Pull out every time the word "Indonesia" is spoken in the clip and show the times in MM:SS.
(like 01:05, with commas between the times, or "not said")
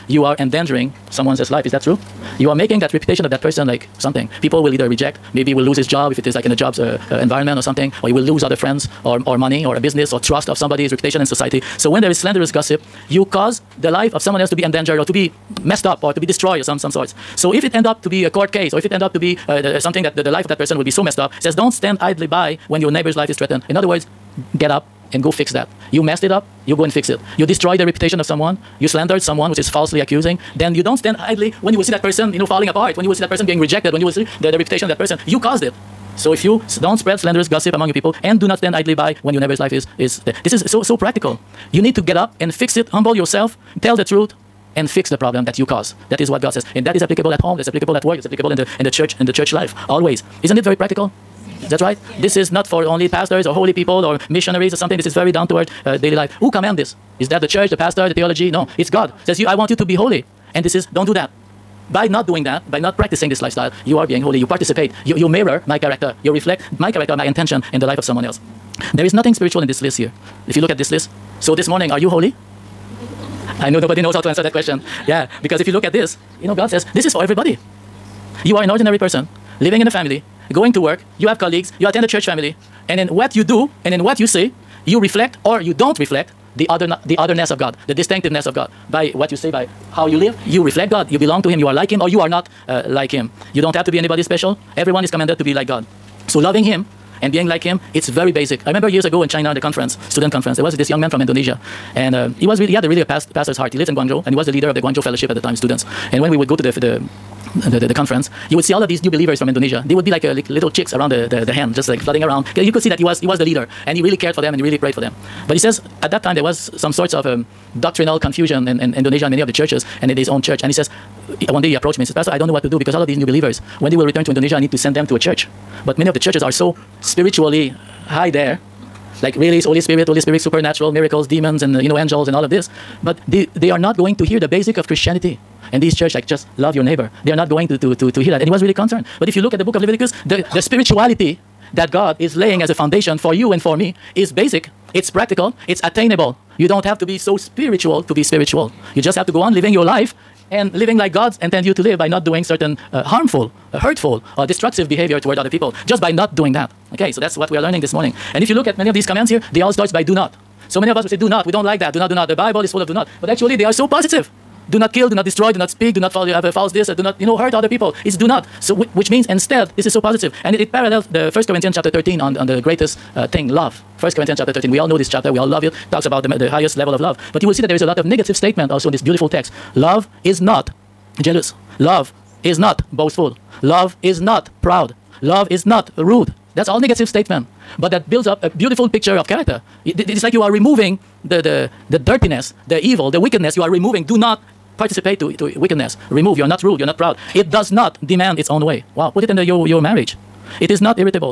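01:41, 01:49, 01:58, 02:04.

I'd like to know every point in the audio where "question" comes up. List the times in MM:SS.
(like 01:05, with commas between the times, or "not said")
01:14.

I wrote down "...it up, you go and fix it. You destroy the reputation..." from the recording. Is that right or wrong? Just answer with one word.
right.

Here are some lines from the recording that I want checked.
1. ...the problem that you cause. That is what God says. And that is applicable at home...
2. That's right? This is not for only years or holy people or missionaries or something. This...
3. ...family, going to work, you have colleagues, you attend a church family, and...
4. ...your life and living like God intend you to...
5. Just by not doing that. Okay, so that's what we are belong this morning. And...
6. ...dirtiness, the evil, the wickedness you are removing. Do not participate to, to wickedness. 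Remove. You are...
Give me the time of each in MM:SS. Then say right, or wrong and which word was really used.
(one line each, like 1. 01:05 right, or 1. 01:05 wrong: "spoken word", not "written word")
1. 00:45 right
2. 00:51 wrong: "pastors", not "years"
3. 01:19 right
4. 02:29 right
5. 02:35 wrong: "learning", not "belong"
6. 03:11 right.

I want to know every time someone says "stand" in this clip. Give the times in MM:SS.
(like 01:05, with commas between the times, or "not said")
00:21, 00:30, 00:38.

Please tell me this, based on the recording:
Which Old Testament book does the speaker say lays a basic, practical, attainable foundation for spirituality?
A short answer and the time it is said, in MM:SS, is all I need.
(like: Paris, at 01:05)
Leviticus, at 02:19.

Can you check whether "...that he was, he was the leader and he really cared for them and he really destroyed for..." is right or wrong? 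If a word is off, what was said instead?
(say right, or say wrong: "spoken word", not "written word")
wrong: "prayed", not "destroyed".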